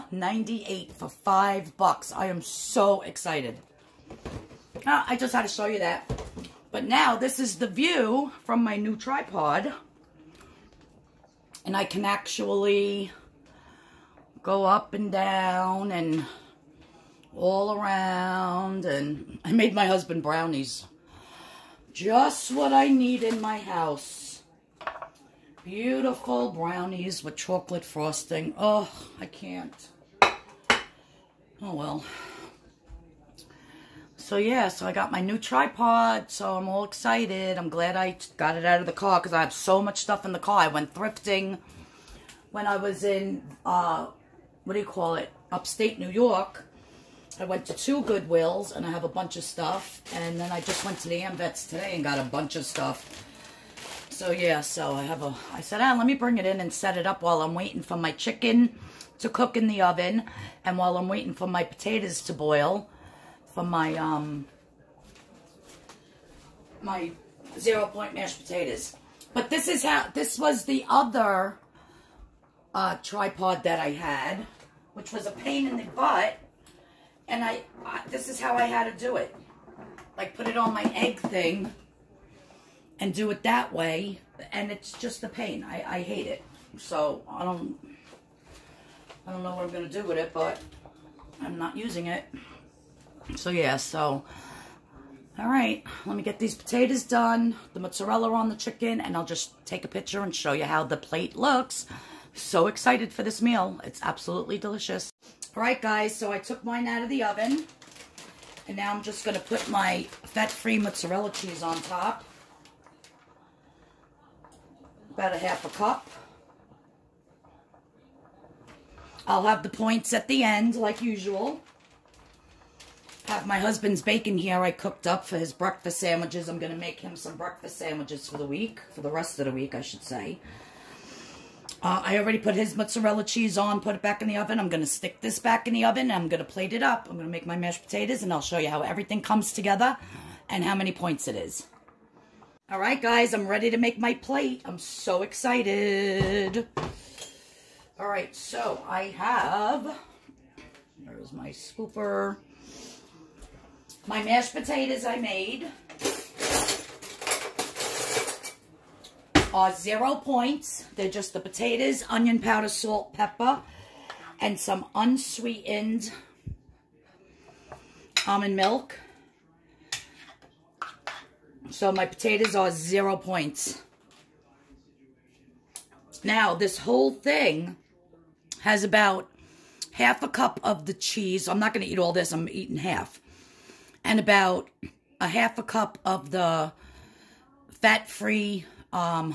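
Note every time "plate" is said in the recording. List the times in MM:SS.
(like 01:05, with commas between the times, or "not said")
01:40, 02:16, 02:24.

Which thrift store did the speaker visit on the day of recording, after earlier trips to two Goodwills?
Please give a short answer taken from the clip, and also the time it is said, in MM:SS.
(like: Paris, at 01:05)
Amvets, at 00:51.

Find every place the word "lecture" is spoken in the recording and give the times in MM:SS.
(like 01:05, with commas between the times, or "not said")
not said.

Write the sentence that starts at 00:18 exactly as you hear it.
And I made my husband brownies.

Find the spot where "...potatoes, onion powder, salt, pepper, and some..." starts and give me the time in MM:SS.
02:41.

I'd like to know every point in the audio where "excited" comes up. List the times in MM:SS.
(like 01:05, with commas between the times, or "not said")
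00:03, 00:36, 01:42, 02:25.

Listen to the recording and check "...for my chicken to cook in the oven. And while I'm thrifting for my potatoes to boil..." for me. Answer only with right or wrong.
wrong.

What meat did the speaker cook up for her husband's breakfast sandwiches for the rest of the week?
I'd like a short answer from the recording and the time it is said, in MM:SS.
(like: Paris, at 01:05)
bacon, at 02:04.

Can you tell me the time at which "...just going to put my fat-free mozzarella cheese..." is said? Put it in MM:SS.
01:49.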